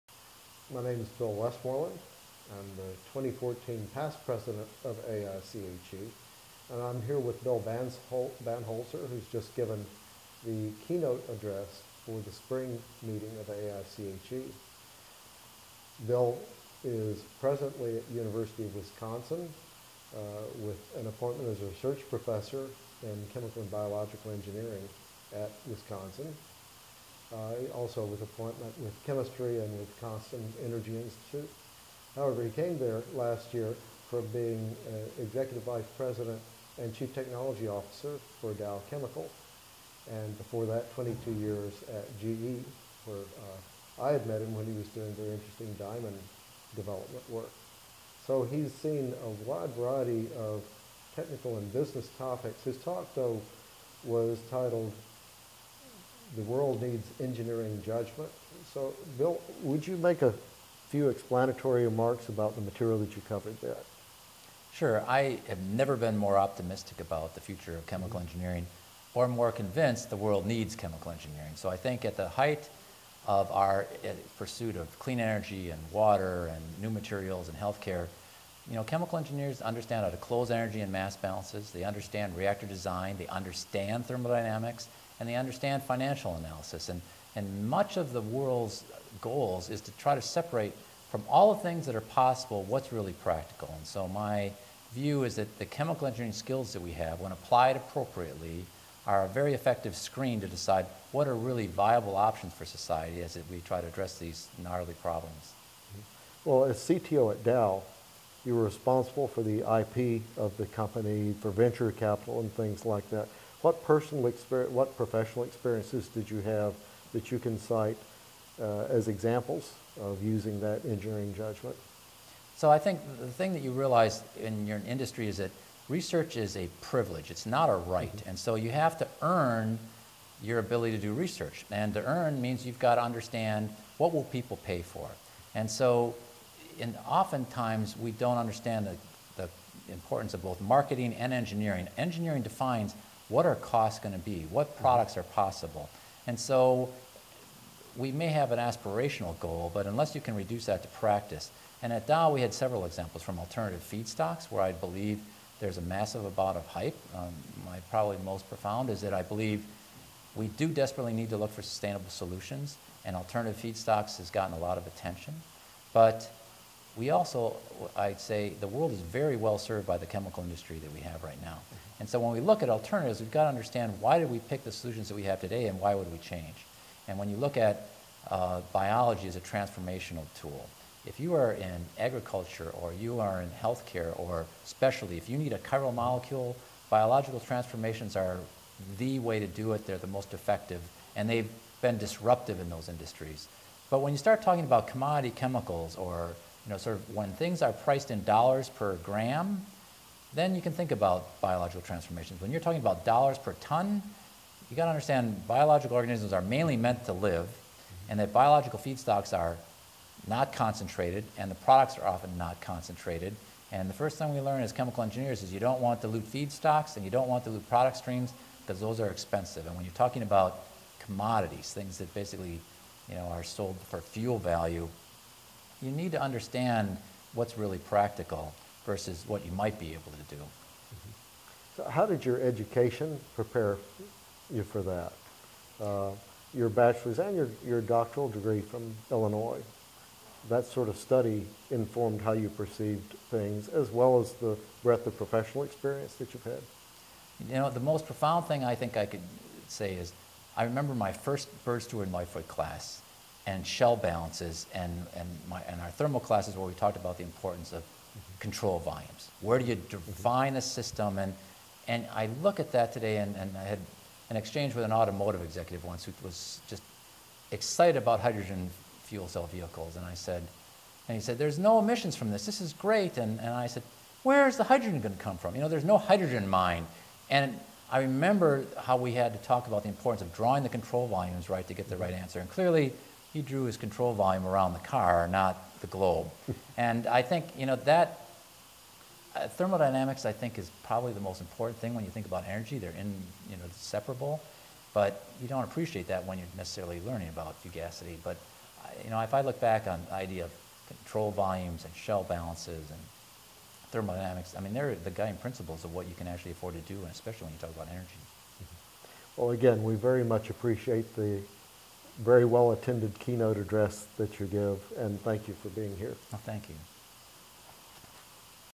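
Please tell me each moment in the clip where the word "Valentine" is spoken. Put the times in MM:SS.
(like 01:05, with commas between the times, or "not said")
not said.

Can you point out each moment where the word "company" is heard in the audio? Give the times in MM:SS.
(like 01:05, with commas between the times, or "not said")
01:50.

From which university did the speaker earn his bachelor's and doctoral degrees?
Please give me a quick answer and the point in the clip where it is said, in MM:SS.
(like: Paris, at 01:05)
Illinois, at 03:59.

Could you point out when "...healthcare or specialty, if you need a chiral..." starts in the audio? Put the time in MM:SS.
03:03.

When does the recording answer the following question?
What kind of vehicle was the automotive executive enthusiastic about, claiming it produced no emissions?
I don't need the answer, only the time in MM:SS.
04:28.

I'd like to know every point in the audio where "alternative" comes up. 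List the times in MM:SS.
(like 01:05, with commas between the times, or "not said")
02:33, 02:43, 02:52.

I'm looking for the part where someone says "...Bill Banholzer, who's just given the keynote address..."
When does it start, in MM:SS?
00:07.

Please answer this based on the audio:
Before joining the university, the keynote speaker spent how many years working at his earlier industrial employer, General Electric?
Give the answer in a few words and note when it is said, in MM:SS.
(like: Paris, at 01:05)
22, at 00:40.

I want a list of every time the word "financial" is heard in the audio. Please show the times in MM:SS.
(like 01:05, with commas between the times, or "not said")
01:25.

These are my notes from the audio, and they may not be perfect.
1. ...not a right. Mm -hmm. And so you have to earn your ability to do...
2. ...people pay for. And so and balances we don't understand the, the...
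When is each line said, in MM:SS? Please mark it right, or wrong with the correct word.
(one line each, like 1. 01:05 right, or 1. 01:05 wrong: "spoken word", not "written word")
1. 02:07 right
2. 02:14 wrong: "oftentimes", not "balances".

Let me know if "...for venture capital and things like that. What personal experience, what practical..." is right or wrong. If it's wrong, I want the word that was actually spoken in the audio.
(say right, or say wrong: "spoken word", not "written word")
wrong: "professional", not "practical".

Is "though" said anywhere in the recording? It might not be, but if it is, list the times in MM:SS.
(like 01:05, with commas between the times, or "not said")
00:53.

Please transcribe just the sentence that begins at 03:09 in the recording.
They're the most effective, and they've been disruptive in those industries.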